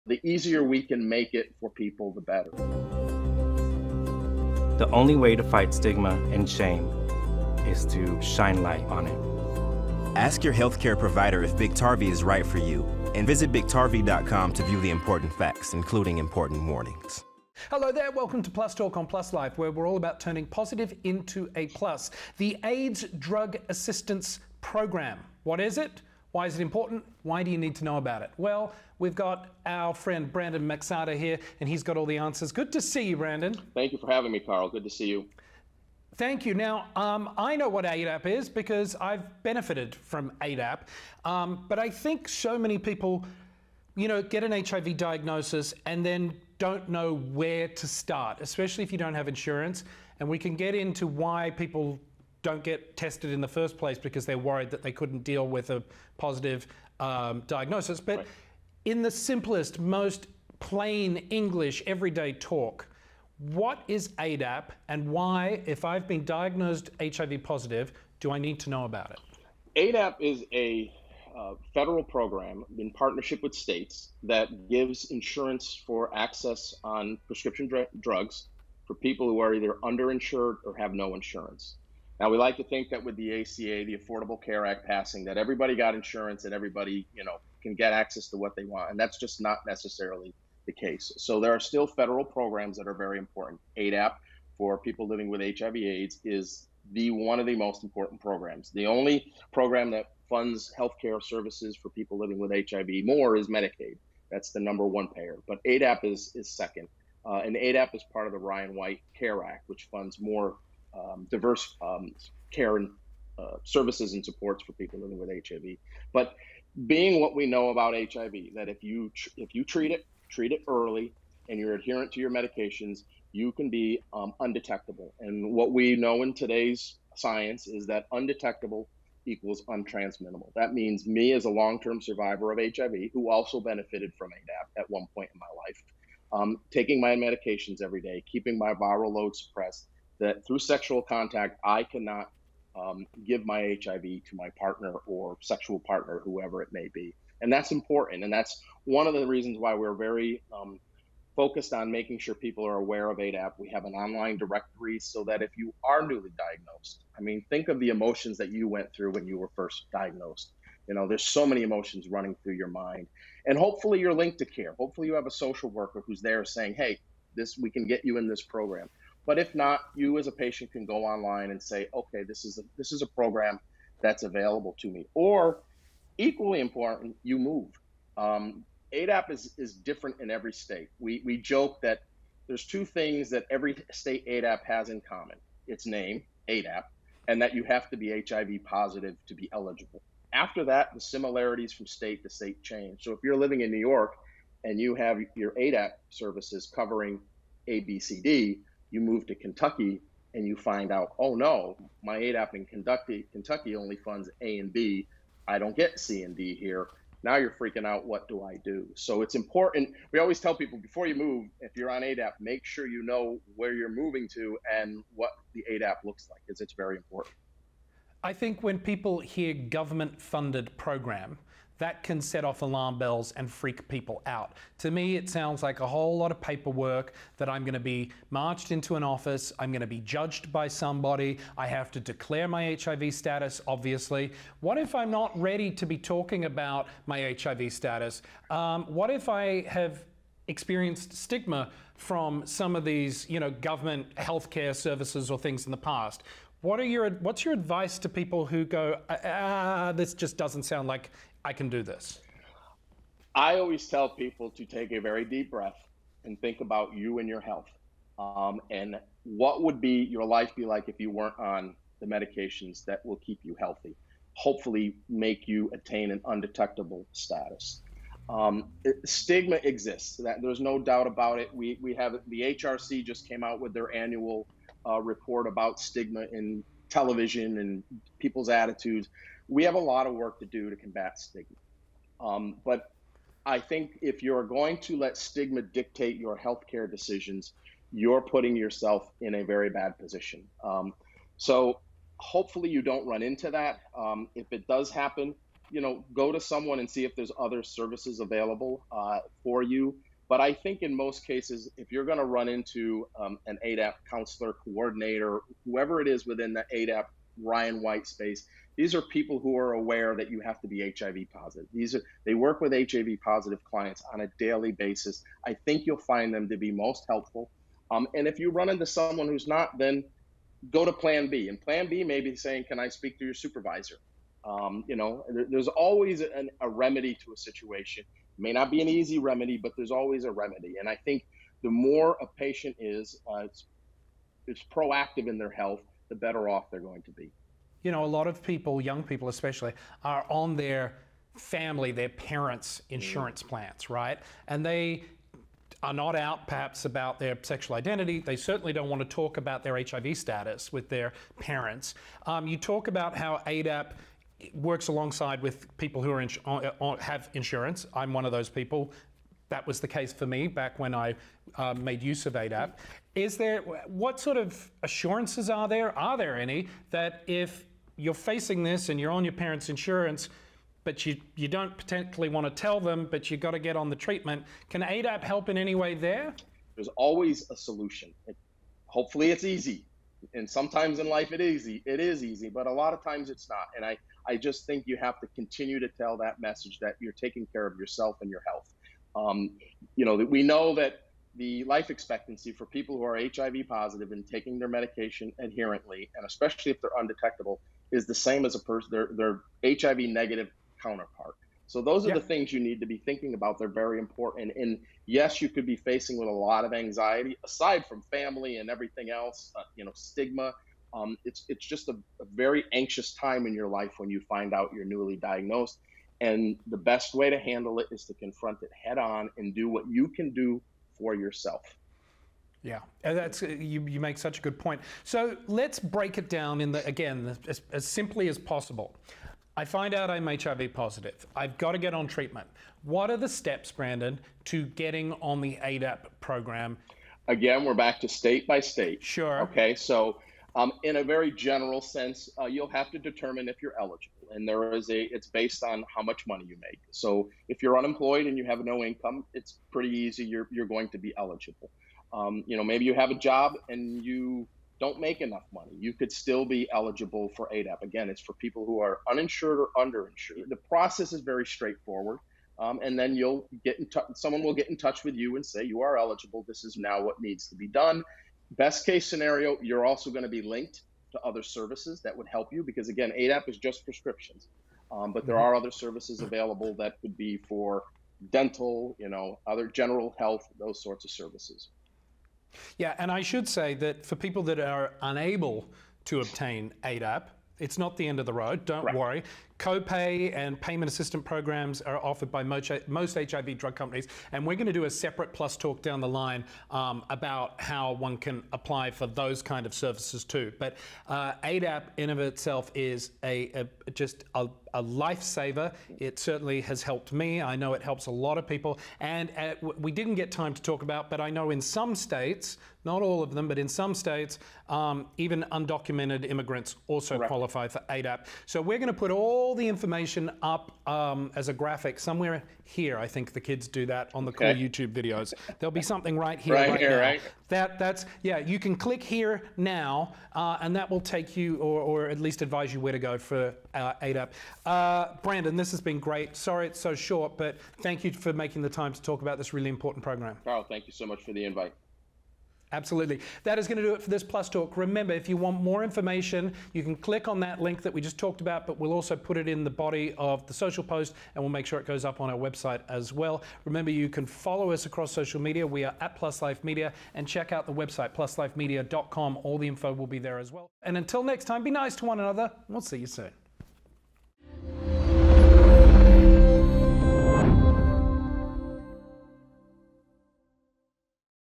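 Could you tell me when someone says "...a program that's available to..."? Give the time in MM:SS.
02:53.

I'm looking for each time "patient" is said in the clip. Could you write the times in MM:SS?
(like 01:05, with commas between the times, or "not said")
02:50, 05:32.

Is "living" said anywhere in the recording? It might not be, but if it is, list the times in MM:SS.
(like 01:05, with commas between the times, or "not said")
01:35, 01:42, 01:54, 03:13.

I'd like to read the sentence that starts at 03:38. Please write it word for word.
I think when people hear government funded program, that can set off alarm bells and freak people out.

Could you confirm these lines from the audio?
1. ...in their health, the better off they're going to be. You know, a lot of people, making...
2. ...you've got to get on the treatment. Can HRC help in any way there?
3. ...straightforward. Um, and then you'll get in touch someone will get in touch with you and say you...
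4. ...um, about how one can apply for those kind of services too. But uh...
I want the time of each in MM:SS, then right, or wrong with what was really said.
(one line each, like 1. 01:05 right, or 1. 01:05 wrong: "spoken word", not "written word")
1. 05:35 wrong: "young", not "making"
2. 06:13 wrong: "ADAP", not "HRC"
3. 07:41 right
4. 08:16 right.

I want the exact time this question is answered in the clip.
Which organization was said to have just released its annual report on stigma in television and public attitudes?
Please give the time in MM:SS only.
04:32.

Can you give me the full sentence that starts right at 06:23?
And I I just think you have to continue to tell that message that you're taking care of yourself and your health.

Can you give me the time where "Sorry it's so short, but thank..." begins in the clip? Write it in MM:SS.
08:56.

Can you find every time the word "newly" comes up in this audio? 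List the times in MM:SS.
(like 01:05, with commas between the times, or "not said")
02:36, 06:54.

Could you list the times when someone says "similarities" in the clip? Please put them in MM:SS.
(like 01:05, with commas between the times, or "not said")
03:10.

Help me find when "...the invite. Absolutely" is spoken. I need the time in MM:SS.
09:01.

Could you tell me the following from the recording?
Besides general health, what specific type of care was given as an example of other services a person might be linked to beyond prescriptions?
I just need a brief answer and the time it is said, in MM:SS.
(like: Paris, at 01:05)
Dental, at 07:58.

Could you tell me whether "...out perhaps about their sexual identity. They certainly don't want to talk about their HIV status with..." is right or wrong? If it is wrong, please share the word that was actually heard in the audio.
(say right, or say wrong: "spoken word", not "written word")
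right.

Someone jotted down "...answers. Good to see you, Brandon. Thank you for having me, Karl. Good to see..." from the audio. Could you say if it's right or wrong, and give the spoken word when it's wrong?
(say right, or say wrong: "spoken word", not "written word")
right.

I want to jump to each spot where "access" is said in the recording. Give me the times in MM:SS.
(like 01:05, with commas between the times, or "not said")
01:16, 01:27.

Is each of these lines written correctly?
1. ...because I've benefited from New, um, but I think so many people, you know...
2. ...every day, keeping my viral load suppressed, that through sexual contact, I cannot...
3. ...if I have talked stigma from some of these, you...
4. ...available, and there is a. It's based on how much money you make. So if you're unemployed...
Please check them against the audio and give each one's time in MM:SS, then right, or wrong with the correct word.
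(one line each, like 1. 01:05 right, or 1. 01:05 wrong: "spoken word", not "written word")
1. 00:38 wrong: "ADAP", not "New"
2. 02:17 right
3. 03:59 wrong: "experienced", not "talked"
4. 07:23 wrong: "eligible", not "available".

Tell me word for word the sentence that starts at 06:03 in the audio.
Is there what sort of assurances are there?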